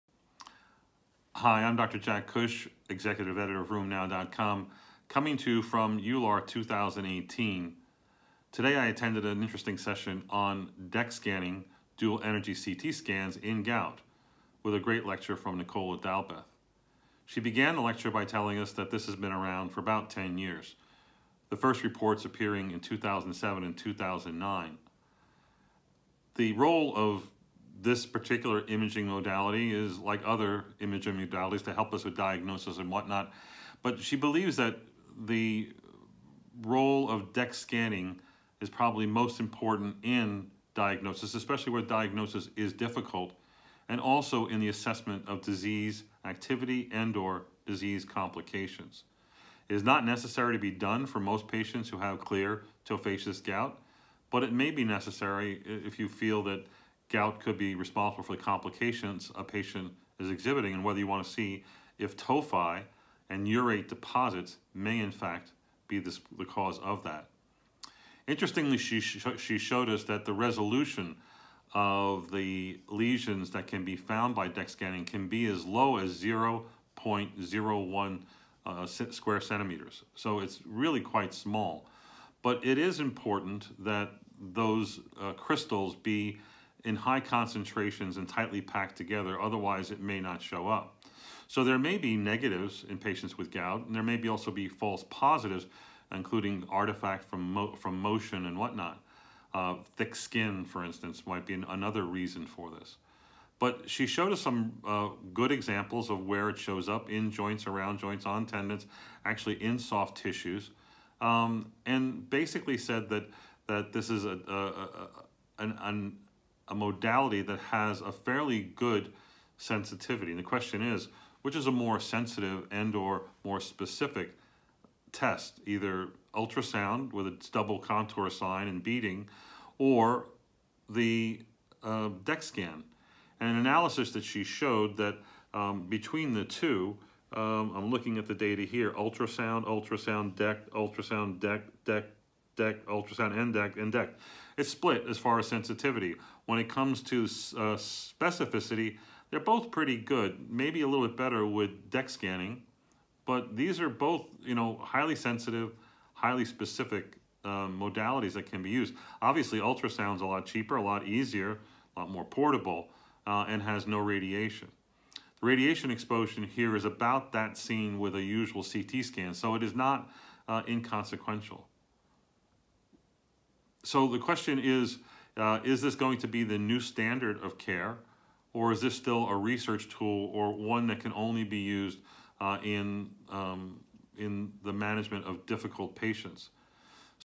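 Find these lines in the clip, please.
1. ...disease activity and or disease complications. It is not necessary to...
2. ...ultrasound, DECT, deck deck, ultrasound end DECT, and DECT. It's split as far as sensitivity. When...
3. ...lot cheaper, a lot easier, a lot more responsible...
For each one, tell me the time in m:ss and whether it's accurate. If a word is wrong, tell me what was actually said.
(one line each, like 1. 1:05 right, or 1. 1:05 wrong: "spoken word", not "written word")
1. 0:45 right
2. 2:20 right
3. 2:40 wrong: "portable", not "responsible".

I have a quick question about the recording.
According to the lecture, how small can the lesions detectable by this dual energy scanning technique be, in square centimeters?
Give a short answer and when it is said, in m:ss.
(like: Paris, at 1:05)
0.01, at 1:16.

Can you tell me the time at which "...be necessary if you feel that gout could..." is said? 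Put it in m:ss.
0:54.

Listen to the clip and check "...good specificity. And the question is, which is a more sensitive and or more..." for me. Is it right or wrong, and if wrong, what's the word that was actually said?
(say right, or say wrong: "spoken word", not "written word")
wrong: "sensitivity", not "specificity".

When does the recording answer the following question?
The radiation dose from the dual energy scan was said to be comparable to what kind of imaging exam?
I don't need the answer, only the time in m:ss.
2:48.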